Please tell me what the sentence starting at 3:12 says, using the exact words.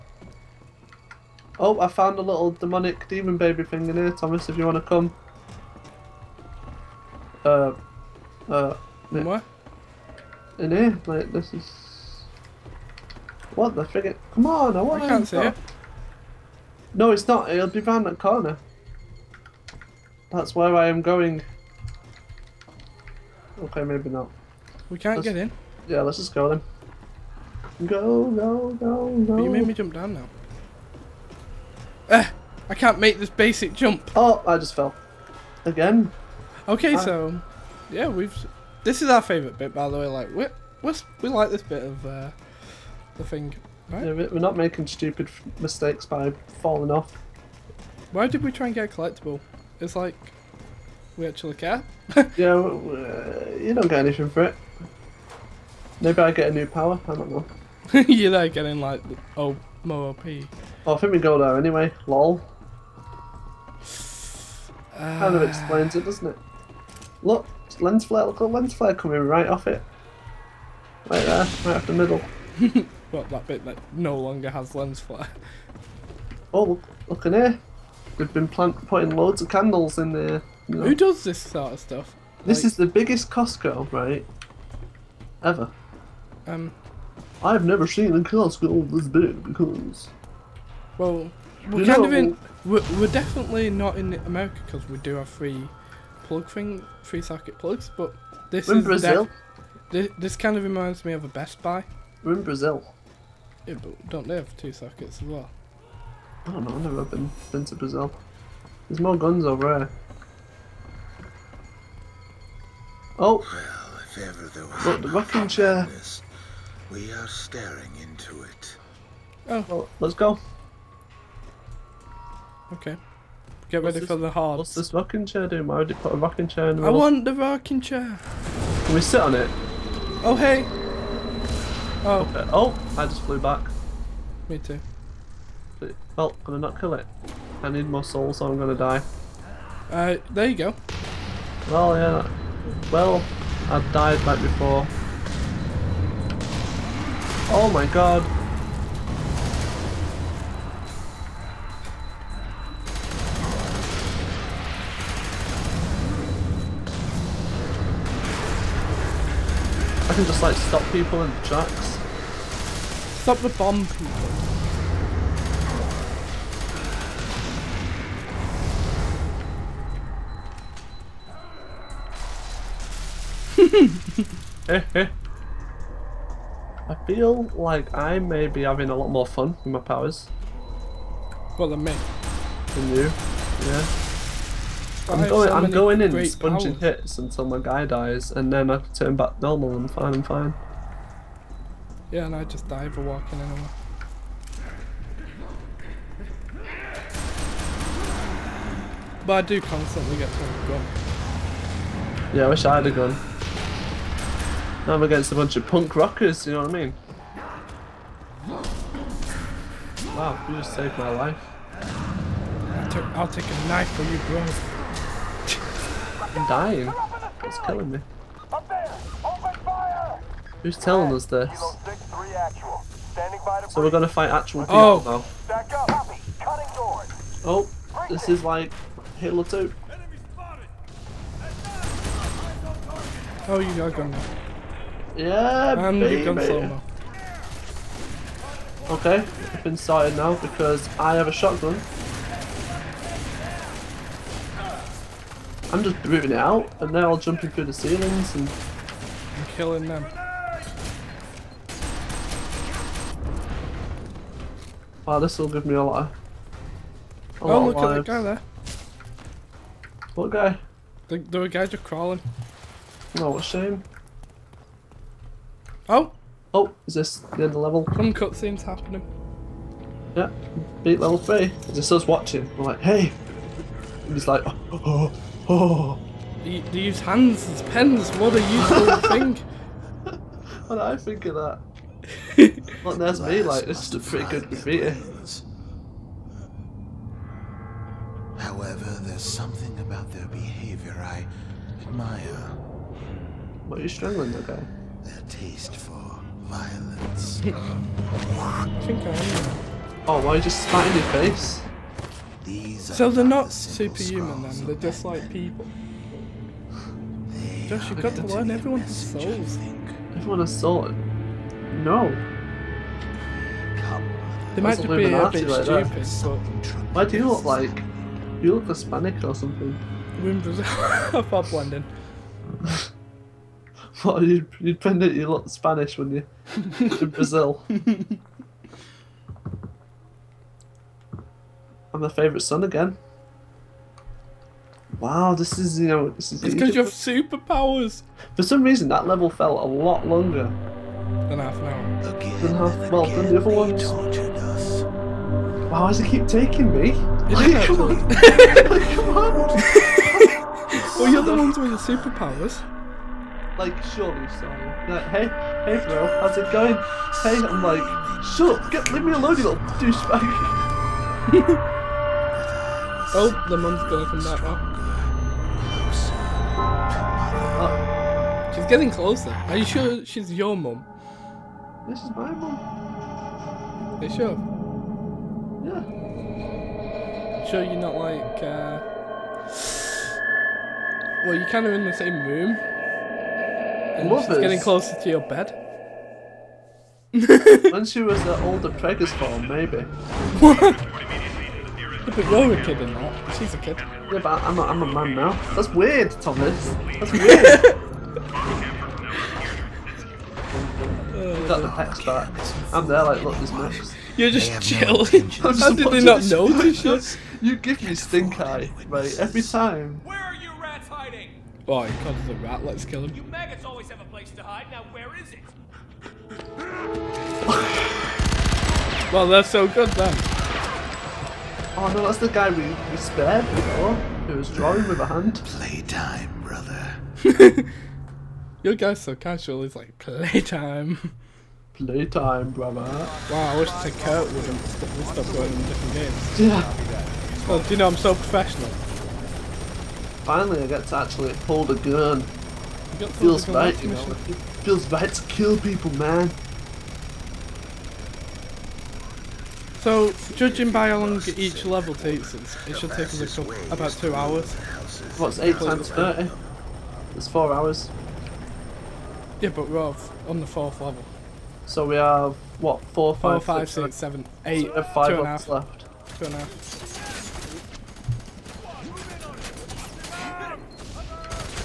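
Yeah, and I just die for walking anyway.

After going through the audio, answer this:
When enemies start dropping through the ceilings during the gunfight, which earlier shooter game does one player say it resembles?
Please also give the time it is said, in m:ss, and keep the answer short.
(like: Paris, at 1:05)
Halo 2, at 3:49.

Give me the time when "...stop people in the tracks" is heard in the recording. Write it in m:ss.
2:40.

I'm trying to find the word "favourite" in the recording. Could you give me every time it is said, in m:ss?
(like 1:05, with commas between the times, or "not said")
0:39, 5:32.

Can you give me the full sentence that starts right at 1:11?
Right there, right off the middle.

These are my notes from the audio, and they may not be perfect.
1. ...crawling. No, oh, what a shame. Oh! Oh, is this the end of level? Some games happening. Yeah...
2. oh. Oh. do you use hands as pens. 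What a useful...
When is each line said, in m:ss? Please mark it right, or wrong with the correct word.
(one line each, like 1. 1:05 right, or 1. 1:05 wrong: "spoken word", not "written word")
1. 4:21 wrong: "cutscenes", not "games"
2. 4:34 right.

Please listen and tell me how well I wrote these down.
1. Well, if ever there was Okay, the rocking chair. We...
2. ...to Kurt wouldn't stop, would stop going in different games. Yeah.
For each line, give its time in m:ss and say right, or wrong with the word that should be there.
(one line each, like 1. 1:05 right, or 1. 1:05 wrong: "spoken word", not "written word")
1. 1:53 wrong: "Look", not "Okay"
2. 7:13 right.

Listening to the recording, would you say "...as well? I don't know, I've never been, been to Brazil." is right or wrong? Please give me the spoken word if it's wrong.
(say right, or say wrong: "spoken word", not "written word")
right.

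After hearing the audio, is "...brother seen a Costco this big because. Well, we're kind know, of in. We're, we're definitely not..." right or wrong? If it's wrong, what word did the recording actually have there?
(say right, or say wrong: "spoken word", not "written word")
wrong: "never", not "brother".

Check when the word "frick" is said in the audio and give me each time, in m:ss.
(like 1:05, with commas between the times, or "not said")
0:13.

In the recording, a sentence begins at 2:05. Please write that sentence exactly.
Why would you put a rocking chair in the I want the rocking chair.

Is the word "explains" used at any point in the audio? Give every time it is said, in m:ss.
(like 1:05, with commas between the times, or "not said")
1:05.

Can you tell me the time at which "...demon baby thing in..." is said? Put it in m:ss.
0:03.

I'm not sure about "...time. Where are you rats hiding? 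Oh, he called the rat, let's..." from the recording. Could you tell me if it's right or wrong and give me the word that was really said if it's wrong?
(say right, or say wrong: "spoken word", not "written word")
right.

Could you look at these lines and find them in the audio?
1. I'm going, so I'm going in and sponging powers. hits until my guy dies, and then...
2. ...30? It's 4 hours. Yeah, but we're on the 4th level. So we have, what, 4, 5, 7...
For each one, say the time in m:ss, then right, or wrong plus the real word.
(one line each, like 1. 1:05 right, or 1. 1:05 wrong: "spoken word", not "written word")
1. 3:05 right
2. 7:35 right.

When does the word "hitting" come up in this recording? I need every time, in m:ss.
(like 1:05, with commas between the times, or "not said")
not said.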